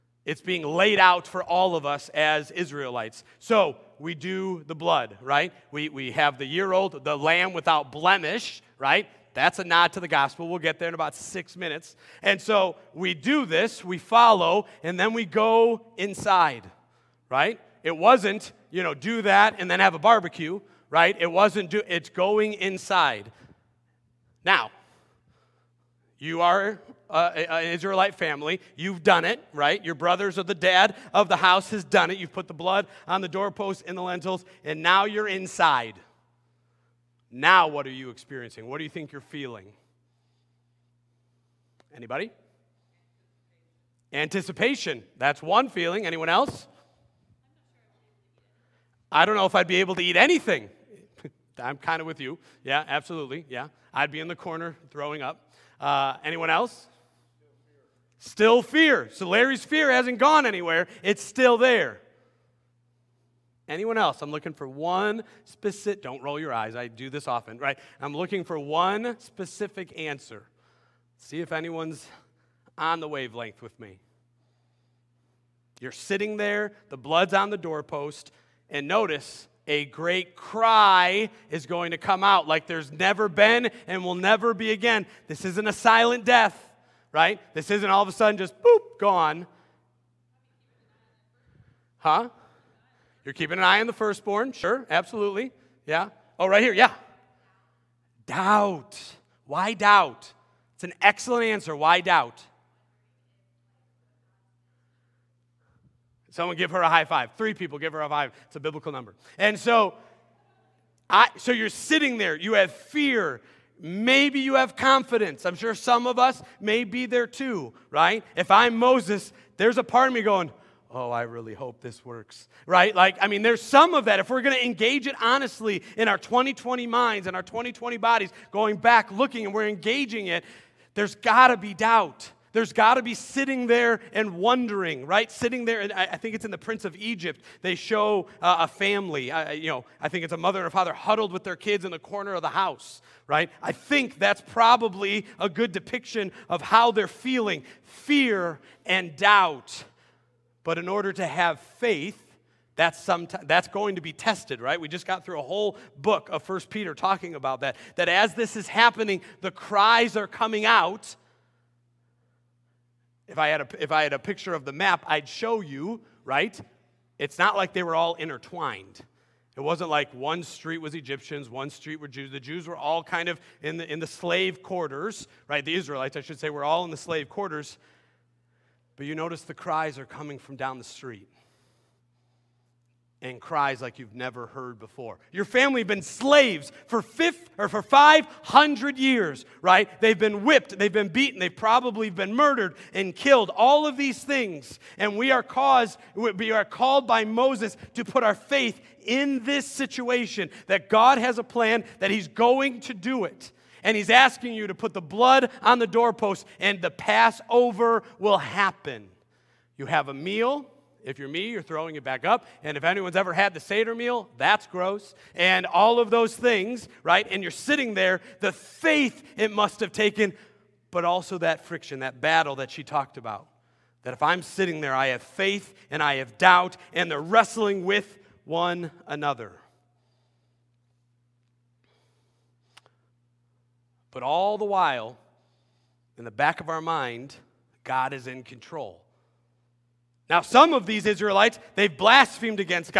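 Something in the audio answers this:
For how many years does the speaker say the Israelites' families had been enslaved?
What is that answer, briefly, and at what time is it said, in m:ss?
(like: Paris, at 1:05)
500, at 3:07.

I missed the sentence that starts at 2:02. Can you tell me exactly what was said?
Like, I mean, there's some of that.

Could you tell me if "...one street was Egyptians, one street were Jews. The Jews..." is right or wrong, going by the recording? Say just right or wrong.
right.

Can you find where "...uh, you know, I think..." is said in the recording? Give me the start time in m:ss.
2:19.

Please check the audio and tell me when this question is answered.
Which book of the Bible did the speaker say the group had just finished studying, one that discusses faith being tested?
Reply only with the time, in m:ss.
2:36.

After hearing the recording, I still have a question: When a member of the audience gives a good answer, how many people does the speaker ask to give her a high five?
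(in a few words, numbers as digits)
3.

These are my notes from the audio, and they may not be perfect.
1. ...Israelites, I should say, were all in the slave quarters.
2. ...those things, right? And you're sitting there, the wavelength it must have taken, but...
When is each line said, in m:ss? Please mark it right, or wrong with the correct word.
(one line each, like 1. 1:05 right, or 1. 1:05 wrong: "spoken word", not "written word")
1. 2:55 right
2. 3:36 wrong: "faith", not "wavelength".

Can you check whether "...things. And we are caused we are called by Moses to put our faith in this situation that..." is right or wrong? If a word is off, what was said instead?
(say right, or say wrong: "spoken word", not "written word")
right.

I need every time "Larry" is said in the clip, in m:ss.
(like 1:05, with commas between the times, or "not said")
0:59.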